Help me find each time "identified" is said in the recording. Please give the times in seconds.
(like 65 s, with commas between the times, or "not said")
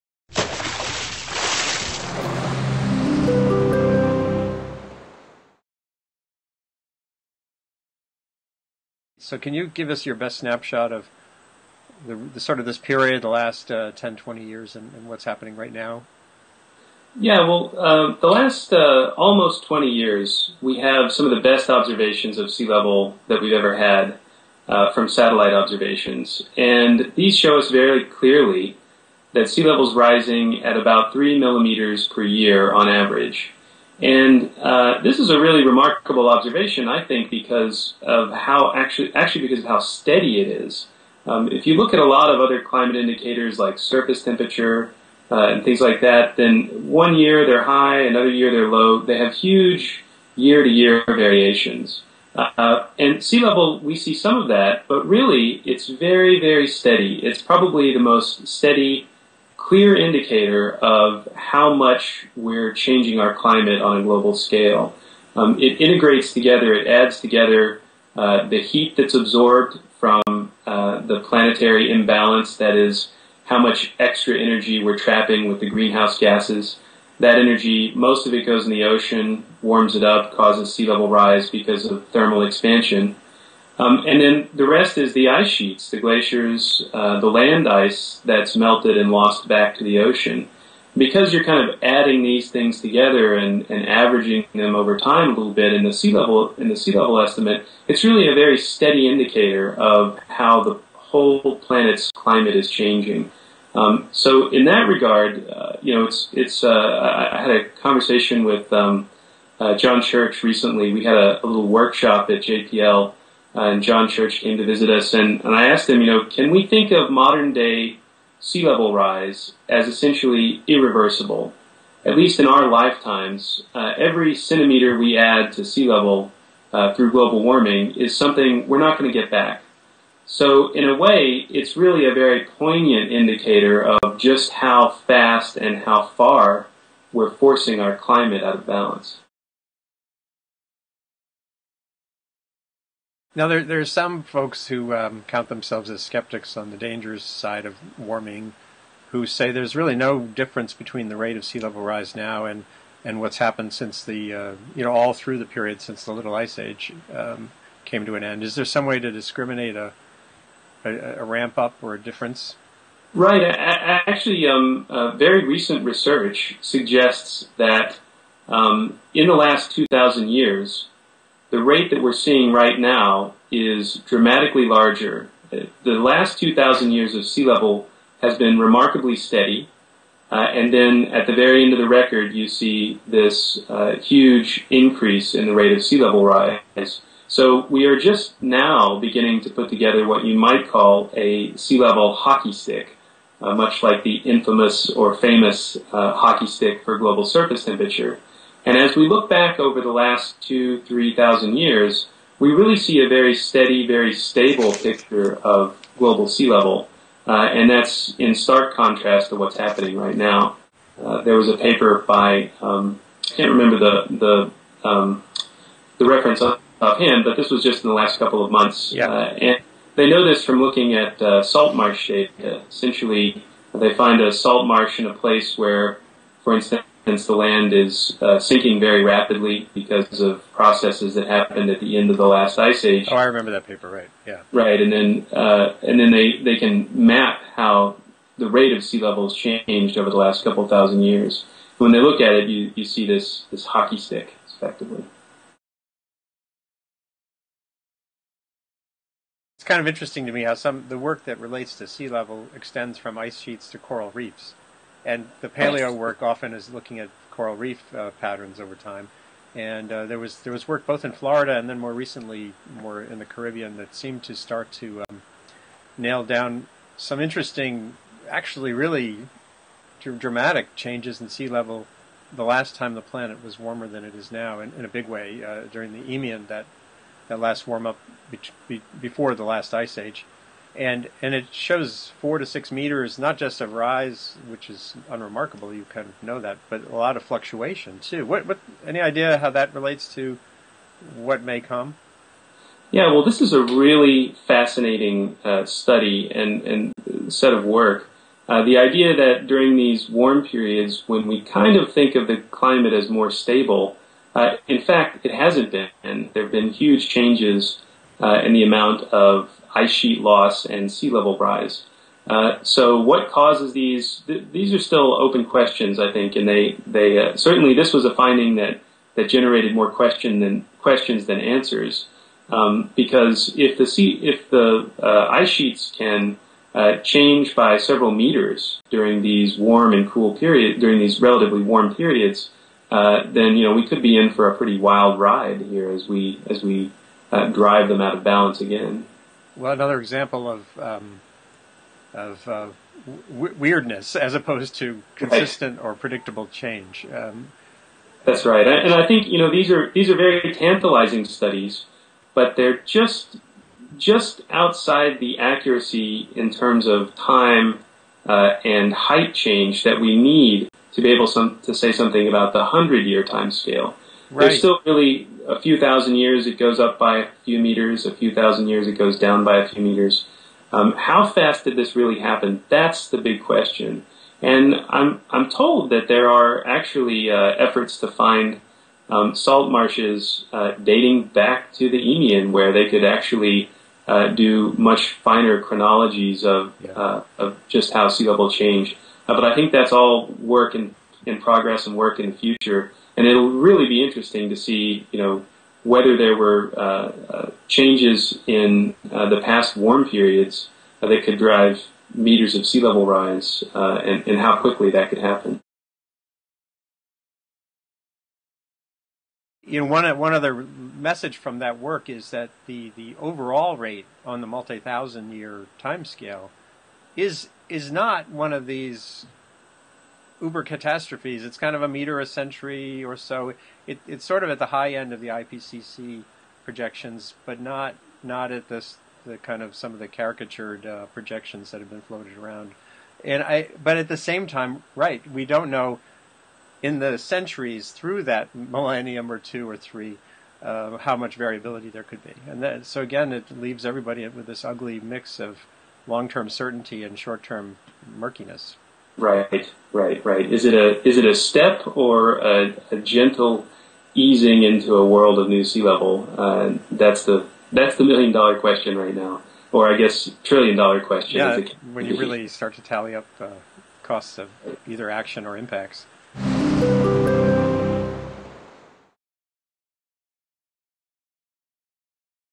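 not said.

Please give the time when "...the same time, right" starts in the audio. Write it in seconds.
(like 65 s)
434 s.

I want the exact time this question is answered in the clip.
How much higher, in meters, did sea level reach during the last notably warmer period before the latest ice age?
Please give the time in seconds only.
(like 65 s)
282 s.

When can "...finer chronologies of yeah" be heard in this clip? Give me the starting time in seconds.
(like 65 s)
385 s.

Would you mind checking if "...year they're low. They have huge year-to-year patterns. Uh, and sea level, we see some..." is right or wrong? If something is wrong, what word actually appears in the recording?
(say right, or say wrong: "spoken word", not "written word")
wrong: "variations", not "patterns".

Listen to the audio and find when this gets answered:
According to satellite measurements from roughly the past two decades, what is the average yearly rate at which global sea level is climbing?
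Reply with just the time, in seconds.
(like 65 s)
31 s.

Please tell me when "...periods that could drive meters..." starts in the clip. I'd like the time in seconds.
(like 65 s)
400 s.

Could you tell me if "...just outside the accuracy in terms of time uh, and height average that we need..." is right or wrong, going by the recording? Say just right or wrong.
wrong.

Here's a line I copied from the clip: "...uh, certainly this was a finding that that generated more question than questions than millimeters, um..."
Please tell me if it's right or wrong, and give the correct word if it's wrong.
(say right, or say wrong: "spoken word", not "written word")
wrong: "answers", not "millimeters".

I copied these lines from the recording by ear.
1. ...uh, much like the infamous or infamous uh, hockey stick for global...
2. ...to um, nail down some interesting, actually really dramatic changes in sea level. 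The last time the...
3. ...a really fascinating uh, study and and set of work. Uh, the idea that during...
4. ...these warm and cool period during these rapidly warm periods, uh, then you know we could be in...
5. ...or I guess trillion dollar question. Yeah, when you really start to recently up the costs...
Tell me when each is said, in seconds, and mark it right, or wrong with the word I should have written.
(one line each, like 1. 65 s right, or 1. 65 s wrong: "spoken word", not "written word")
1. 193 s wrong: "famous", not "infamous"
2. 264 s right
3. 293 s right
4. 329 s wrong: "relatively", not "rapidly"
5. 459 s wrong: "tally", not "recently".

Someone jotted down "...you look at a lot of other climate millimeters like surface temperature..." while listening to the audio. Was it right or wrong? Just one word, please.
wrong.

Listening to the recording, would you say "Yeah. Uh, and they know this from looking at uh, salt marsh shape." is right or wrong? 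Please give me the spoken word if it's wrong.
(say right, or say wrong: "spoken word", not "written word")
right.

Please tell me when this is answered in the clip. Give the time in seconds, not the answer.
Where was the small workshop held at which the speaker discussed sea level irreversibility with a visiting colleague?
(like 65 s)
112 s.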